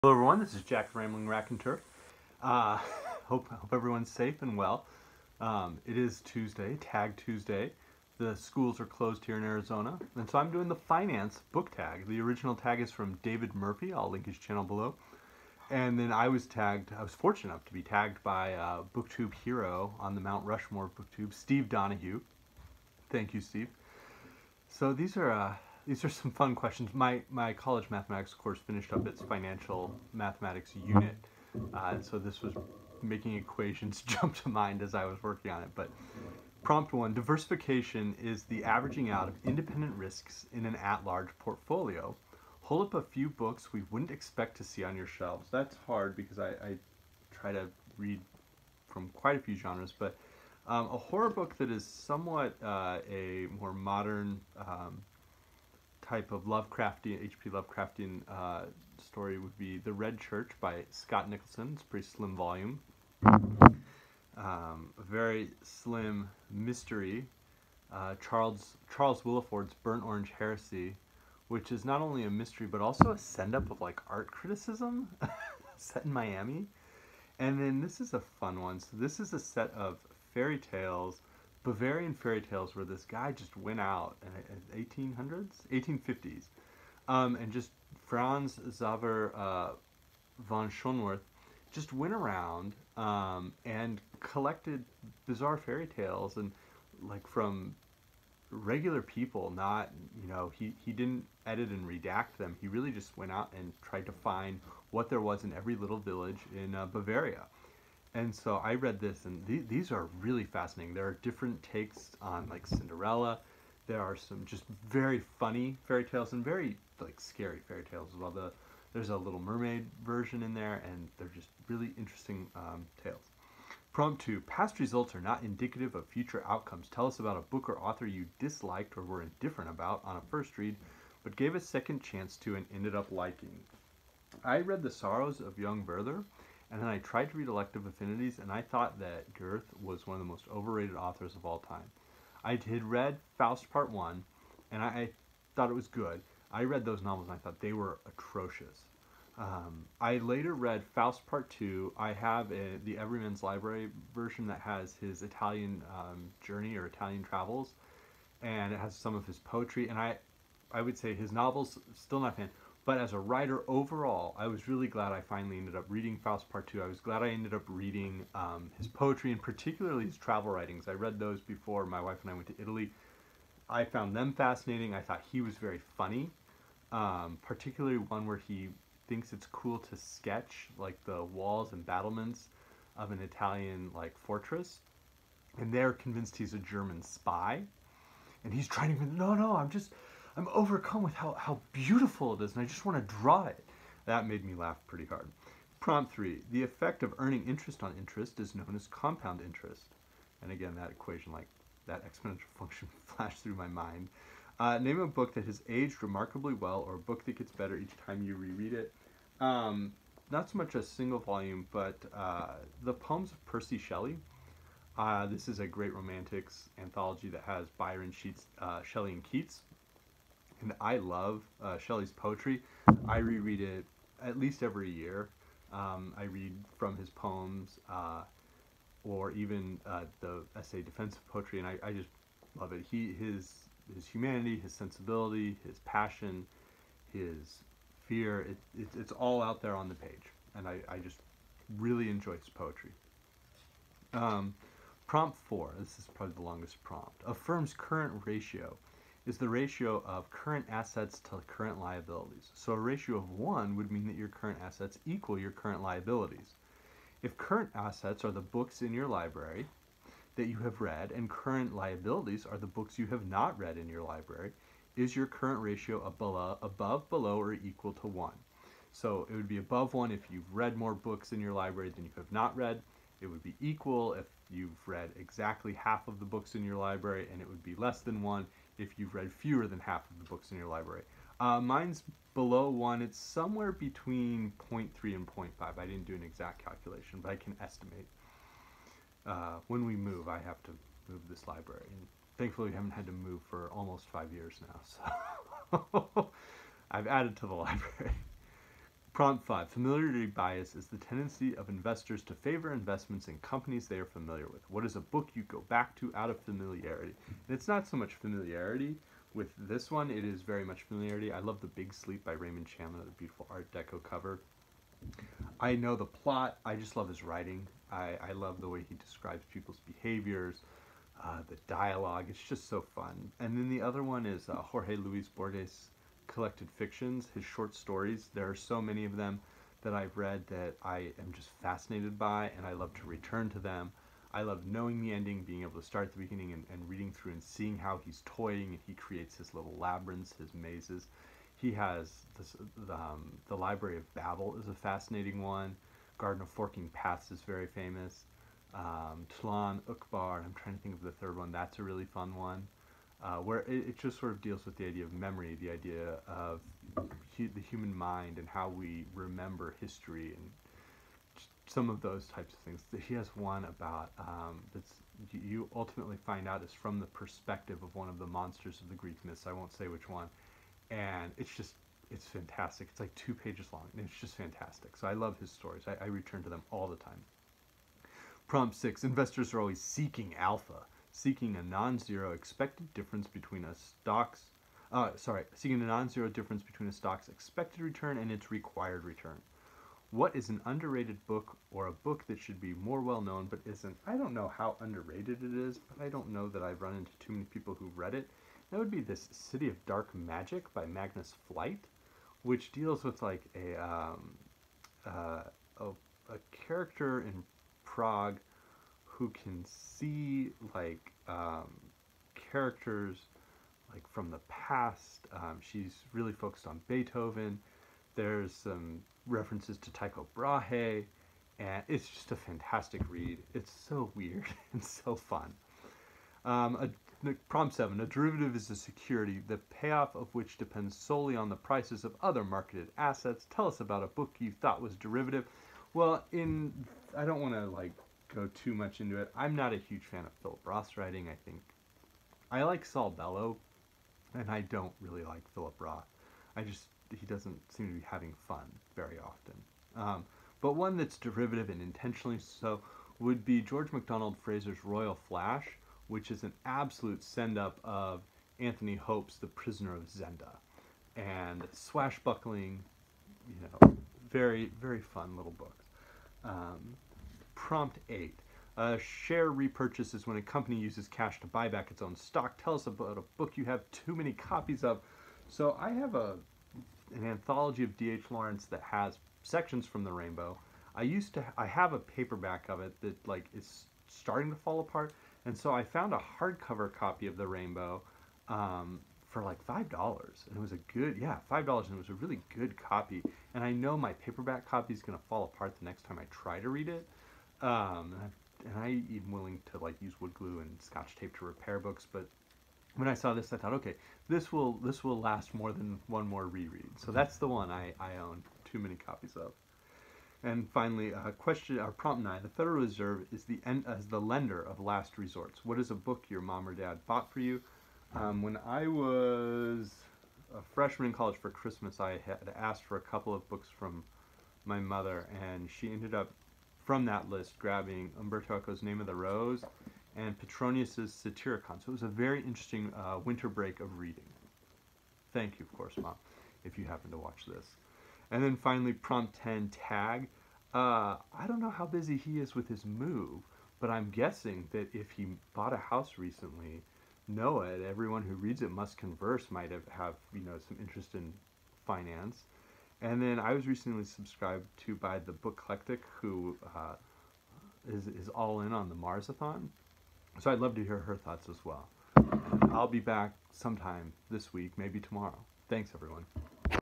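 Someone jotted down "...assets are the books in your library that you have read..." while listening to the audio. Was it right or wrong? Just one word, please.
right.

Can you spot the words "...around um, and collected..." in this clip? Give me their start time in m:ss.
1:32.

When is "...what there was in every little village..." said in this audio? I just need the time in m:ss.
1:44.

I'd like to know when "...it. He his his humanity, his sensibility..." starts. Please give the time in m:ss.
3:52.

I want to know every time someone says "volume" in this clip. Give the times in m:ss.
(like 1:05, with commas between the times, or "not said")
1:02, 3:31.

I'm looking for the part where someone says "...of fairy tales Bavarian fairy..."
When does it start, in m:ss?
1:19.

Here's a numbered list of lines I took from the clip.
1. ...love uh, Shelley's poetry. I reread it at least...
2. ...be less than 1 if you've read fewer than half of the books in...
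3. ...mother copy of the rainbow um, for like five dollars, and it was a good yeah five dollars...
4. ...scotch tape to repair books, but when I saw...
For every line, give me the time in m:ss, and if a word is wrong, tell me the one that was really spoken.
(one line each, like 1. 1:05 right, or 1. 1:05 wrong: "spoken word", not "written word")
1. 3:40 right
2. 4:37 right
3. 8:06 wrong: "hardcover", not "mother"
4. 8:20 right.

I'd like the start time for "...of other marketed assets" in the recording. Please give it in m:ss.
7:12.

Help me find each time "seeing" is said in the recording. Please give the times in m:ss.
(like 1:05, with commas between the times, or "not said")
5:37.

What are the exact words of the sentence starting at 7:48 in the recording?
A uh, share repurchase is when a company uses cash to buy back its own stock.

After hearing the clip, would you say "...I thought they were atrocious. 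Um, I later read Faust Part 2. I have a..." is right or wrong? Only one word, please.
right.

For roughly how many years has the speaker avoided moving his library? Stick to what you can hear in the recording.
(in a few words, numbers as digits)
5.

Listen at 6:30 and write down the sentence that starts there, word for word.
What is an underrated book or a book that should be more well known but isn't?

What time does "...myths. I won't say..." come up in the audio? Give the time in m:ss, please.
6:09.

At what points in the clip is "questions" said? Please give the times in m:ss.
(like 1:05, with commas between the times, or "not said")
0:26, 8:31.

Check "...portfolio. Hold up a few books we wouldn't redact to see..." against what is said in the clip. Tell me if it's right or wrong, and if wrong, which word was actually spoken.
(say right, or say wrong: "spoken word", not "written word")
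wrong: "expect", not "redact".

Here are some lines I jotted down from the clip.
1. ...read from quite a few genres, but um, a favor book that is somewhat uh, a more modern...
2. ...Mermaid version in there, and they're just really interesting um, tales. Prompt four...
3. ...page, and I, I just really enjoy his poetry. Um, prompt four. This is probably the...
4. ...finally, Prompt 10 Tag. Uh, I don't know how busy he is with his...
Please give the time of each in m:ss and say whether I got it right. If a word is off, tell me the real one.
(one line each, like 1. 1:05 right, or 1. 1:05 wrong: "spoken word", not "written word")
1. 0:47 wrong: "horror", not "favor"
2. 1:59 wrong: "two", not "four"
3. 3:59 right
4. 8:58 right.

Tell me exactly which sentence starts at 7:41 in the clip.
And swashbuckling, you know, very, very fun little book.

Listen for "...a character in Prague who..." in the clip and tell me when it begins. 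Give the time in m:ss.
6:46.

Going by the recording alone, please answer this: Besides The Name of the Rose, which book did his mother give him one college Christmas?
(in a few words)
Satyricon.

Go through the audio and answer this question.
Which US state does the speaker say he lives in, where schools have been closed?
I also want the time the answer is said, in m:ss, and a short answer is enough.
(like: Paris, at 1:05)
Arizona, at 0:09.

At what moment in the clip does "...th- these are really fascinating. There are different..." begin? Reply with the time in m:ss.
1:49.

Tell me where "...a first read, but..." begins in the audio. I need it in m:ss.
2:10.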